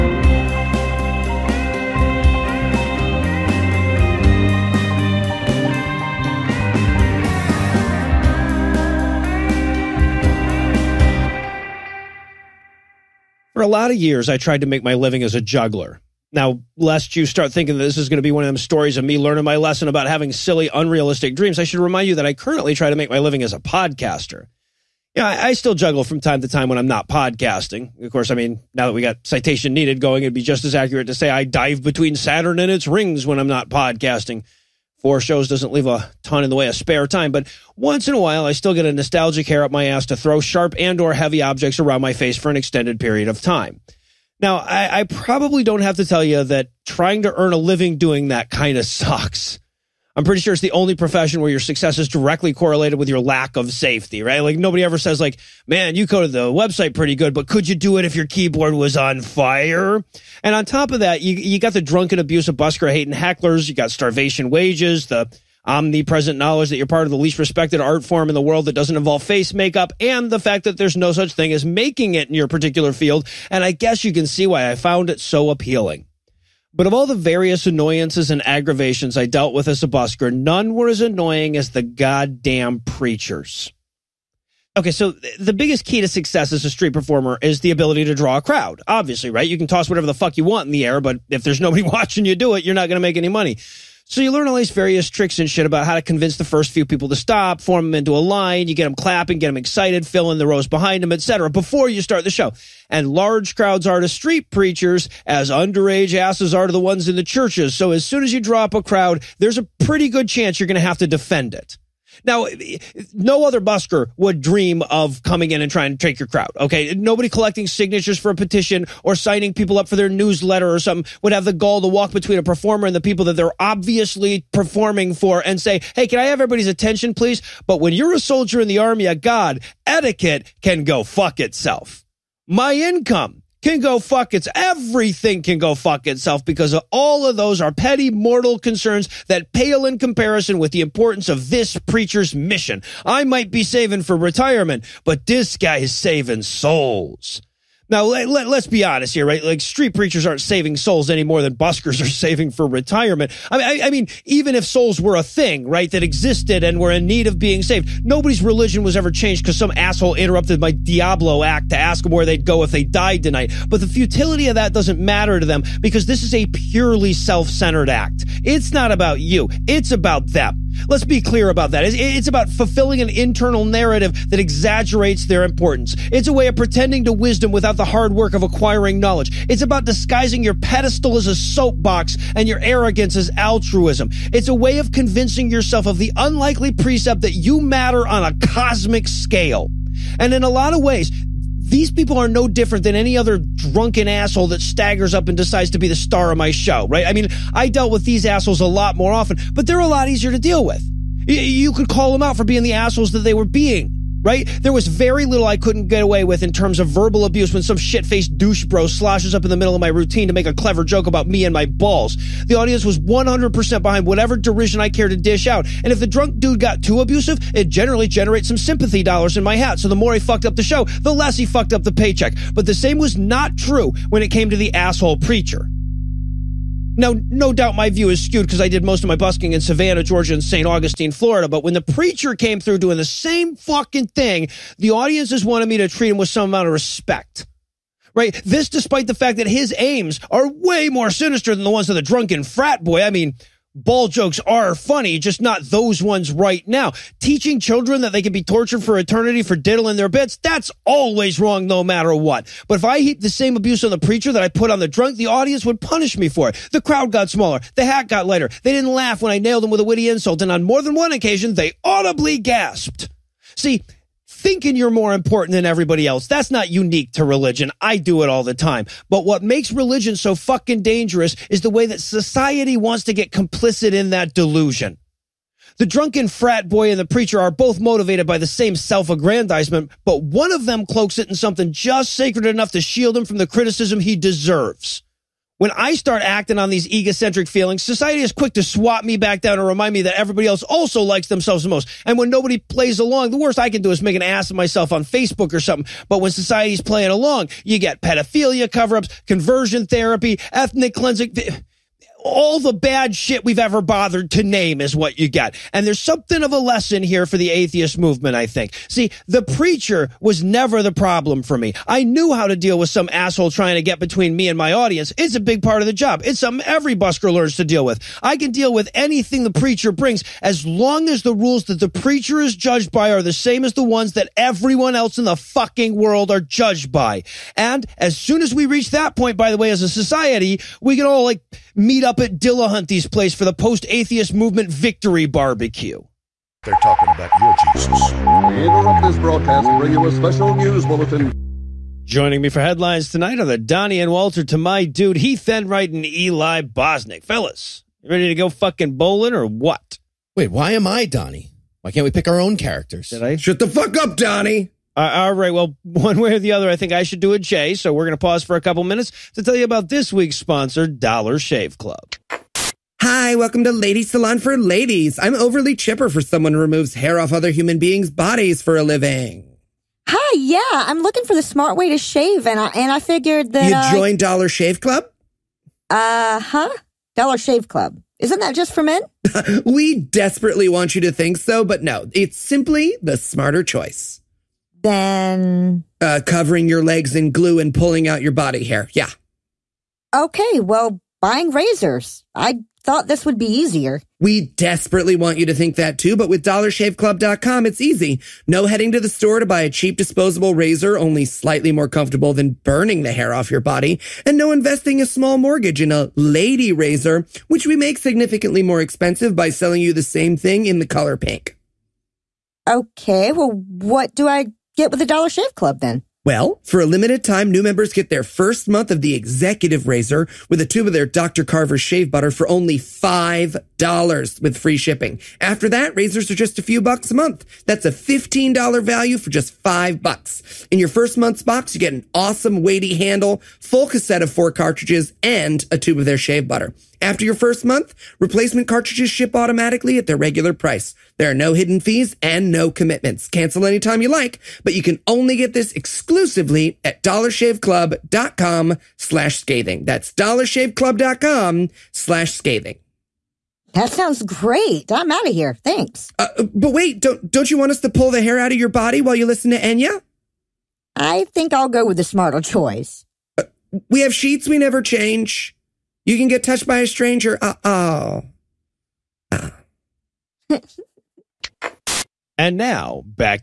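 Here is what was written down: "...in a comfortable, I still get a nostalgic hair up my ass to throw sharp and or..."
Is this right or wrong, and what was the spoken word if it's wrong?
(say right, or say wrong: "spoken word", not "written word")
wrong: "while", not "comfortable".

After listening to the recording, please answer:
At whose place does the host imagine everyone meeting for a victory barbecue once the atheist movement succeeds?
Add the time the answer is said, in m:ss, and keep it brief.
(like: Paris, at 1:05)
Dillahunty, at 5:32.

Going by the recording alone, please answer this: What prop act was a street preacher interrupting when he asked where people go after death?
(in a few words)
diabolo act.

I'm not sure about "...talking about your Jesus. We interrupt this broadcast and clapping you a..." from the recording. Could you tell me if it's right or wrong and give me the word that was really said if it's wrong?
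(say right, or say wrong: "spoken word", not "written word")
wrong: "bring", not "clapping".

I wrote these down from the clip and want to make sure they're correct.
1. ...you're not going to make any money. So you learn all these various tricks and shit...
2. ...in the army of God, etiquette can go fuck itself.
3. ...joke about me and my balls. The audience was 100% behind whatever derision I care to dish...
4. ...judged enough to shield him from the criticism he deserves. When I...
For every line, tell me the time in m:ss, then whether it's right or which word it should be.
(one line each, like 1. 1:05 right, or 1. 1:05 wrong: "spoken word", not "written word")
1. 1:32 right
2. 2:08 right
3. 3:30 right
4. 4:42 wrong: "sacred", not "judged".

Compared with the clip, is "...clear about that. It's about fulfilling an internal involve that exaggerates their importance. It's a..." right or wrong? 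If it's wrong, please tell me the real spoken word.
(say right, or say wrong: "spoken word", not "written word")
wrong: "narrative", not "involve".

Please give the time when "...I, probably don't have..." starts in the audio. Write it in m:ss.
0:44.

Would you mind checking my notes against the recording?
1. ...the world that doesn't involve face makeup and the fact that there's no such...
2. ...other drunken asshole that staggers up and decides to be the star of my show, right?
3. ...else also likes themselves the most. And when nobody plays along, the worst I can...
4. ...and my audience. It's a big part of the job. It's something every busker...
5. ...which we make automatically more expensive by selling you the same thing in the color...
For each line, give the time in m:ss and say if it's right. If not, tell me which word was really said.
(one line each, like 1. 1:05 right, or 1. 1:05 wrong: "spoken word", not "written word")
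1. 1:08 right
2. 3:13 right
3. 4:50 right
4. 5:14 right
5. 6:47 wrong: "significantly", not "automatically".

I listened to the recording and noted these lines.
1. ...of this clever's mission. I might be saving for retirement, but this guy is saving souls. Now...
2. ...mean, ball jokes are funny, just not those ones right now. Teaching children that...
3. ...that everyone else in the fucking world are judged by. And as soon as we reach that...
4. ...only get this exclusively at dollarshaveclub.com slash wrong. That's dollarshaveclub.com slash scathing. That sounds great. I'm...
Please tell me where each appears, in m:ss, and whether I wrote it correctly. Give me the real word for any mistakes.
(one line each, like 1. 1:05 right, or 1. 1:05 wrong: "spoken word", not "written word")
1. 2:21 wrong: "preacher", not "clever"
2. 4:03 right
3. 5:24 right
4. 7:25 wrong: "scathing", not "wrong".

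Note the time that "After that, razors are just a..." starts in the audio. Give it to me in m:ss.
7:05.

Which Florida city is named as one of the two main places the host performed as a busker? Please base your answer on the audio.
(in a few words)
St. Augustine.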